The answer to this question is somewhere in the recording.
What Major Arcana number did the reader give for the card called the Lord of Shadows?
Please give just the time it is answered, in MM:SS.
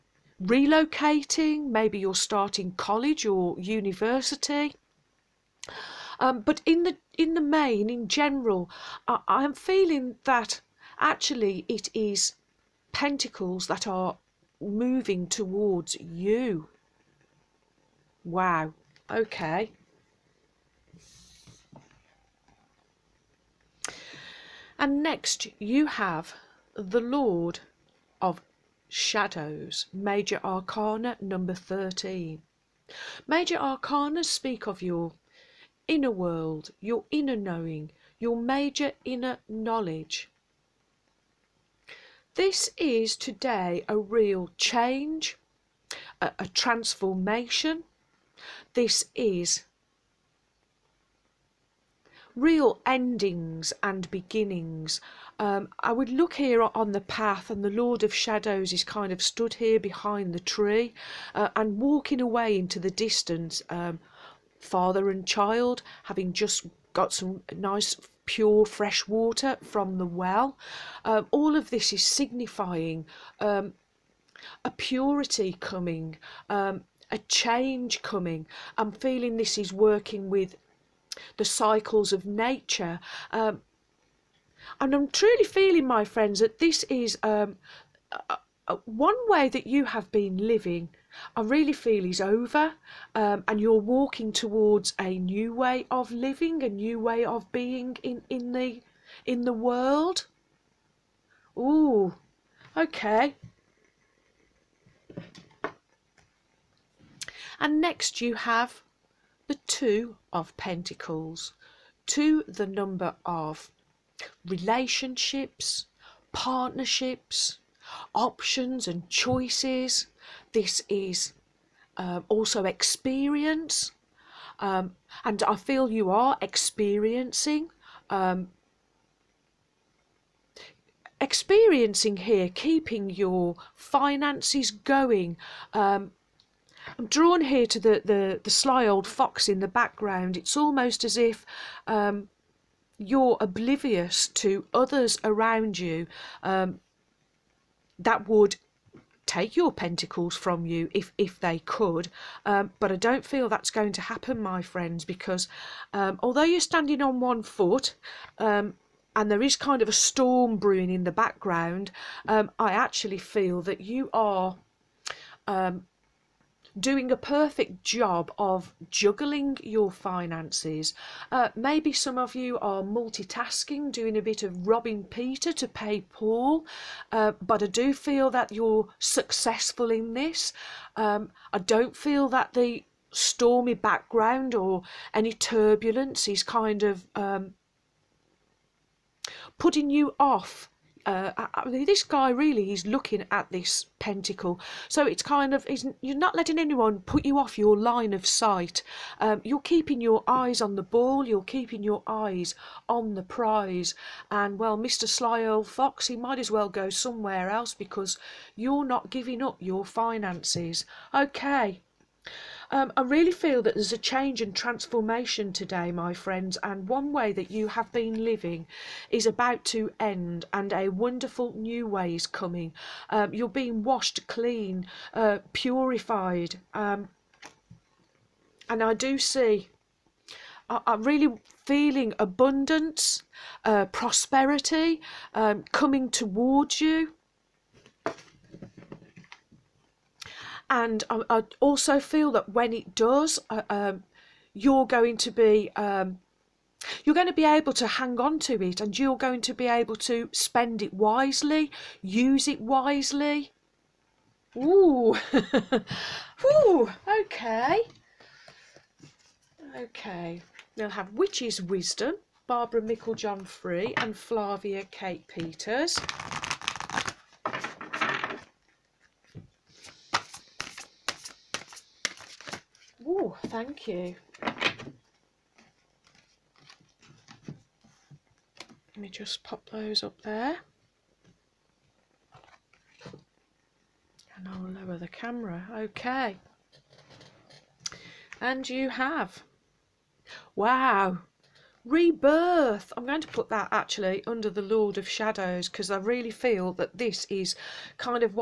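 00:31.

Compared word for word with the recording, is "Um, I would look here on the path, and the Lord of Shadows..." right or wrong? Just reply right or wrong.
right.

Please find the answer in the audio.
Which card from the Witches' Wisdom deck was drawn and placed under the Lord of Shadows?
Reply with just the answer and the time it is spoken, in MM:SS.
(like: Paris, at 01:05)
Rebirth, at 04:51.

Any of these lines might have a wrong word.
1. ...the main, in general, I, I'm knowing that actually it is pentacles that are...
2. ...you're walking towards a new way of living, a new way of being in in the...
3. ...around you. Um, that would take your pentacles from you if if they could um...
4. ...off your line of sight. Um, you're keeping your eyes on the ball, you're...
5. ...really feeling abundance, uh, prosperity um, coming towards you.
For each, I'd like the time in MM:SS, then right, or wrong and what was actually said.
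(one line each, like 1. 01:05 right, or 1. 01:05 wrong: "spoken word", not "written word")
1. 00:07 wrong: "feeling", not "knowing"
2. 01:33 right
3. 02:25 right
4. 03:17 right
5. 03:51 right.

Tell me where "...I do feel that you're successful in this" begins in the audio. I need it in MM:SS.
02:57.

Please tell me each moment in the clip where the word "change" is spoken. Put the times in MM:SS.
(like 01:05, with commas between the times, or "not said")
00:44, 01:17, 03:33.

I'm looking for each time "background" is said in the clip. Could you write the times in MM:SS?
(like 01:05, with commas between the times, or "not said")
02:19, 02:41, 03:03.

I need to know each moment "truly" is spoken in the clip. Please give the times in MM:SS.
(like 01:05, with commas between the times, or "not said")
01:25.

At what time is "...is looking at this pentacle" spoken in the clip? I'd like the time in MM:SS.
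03:12.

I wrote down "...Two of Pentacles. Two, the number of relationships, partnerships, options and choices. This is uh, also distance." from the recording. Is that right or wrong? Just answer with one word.
wrong.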